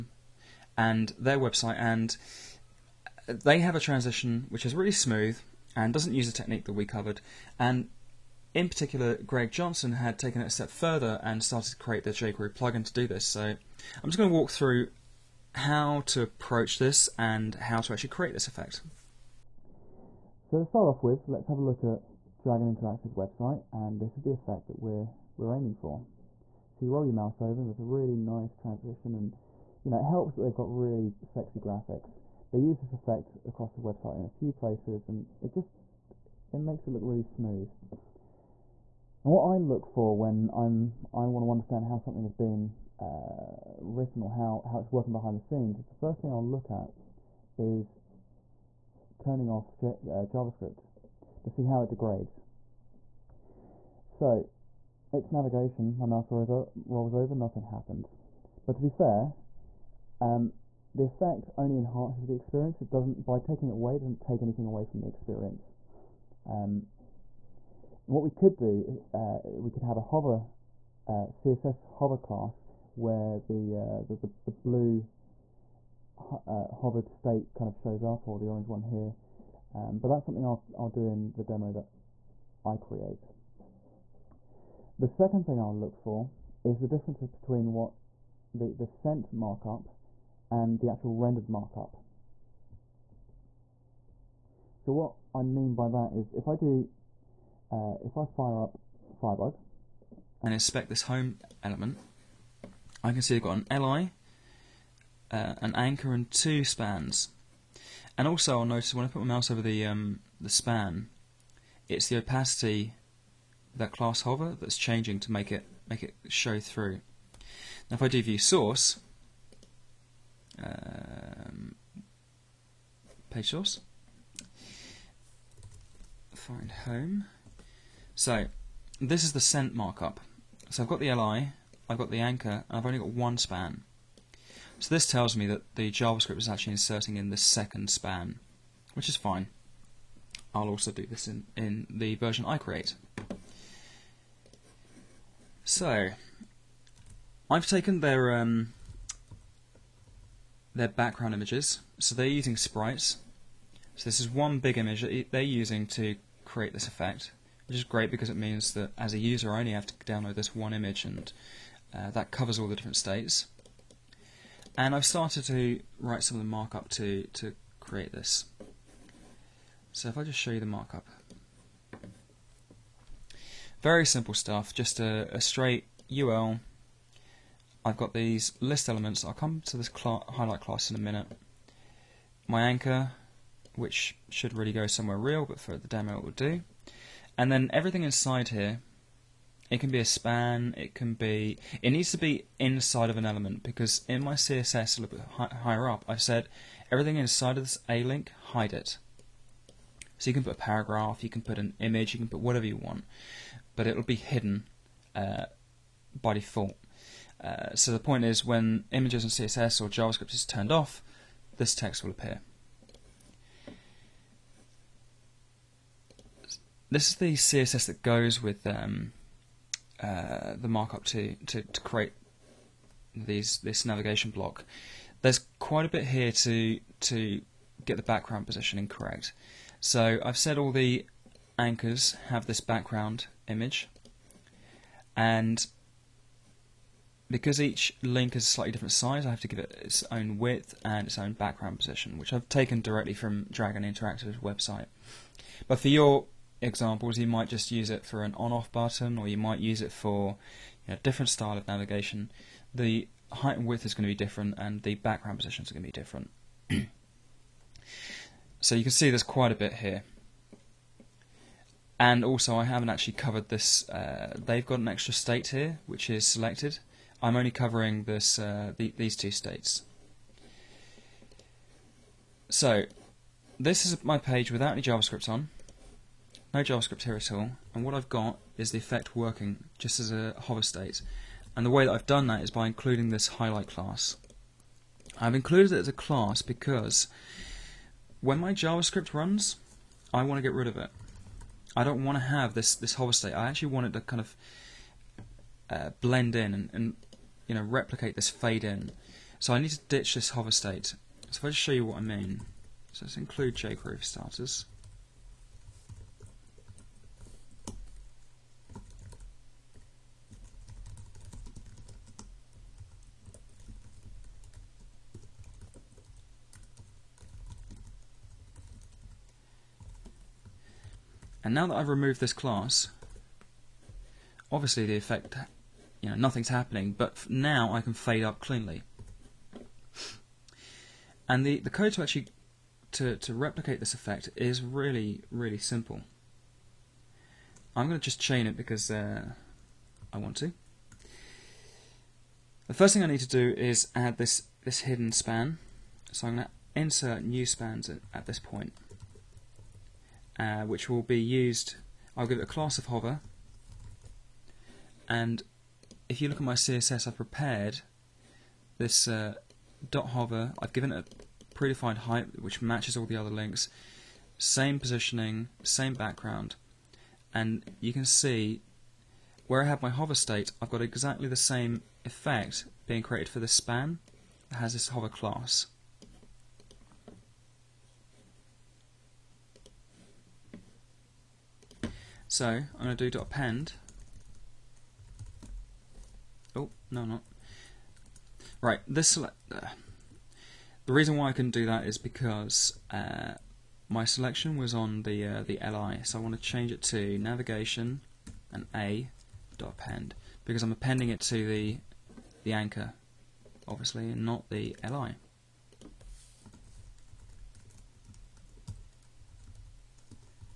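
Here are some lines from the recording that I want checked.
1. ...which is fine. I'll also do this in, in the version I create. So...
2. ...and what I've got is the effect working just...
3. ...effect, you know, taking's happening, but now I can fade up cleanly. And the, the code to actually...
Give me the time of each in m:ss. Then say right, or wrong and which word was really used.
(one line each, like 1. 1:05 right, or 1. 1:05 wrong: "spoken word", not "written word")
1. 2:18 right
2. 4:37 right
3. 5:24 wrong: "nothing", not "taking".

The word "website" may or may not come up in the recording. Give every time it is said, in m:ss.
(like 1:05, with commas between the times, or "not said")
0:01, 0:23, 0:33, 4:04.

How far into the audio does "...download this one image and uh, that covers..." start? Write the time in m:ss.
2:40.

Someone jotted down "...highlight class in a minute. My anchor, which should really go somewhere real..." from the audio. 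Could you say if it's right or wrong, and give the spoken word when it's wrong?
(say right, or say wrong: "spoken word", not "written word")
right.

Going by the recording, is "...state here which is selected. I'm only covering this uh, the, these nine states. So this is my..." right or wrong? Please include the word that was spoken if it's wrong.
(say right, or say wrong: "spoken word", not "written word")
wrong: "two", not "nine".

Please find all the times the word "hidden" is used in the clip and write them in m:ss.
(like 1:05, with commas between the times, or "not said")
3:24, 5:44.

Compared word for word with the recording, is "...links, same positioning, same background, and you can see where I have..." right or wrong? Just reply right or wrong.
right.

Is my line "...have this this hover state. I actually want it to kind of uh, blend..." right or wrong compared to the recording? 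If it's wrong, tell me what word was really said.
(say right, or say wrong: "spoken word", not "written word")
right.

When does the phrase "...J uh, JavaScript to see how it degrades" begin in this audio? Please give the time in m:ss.
0:49.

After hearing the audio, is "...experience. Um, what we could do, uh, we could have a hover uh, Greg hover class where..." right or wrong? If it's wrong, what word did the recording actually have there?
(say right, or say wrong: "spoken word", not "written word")
wrong: "CSS", not "Greg".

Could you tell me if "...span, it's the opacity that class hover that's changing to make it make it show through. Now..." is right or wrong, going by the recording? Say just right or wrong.
right.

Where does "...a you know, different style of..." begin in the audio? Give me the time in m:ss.
4:10.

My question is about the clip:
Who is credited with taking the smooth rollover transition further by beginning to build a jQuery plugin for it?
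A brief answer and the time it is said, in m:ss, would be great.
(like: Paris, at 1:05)
Greg Johnson, at 0:09.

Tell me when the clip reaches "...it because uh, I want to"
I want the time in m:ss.
5:38.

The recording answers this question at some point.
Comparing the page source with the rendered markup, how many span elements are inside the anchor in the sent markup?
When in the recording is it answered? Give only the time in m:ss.
2:13.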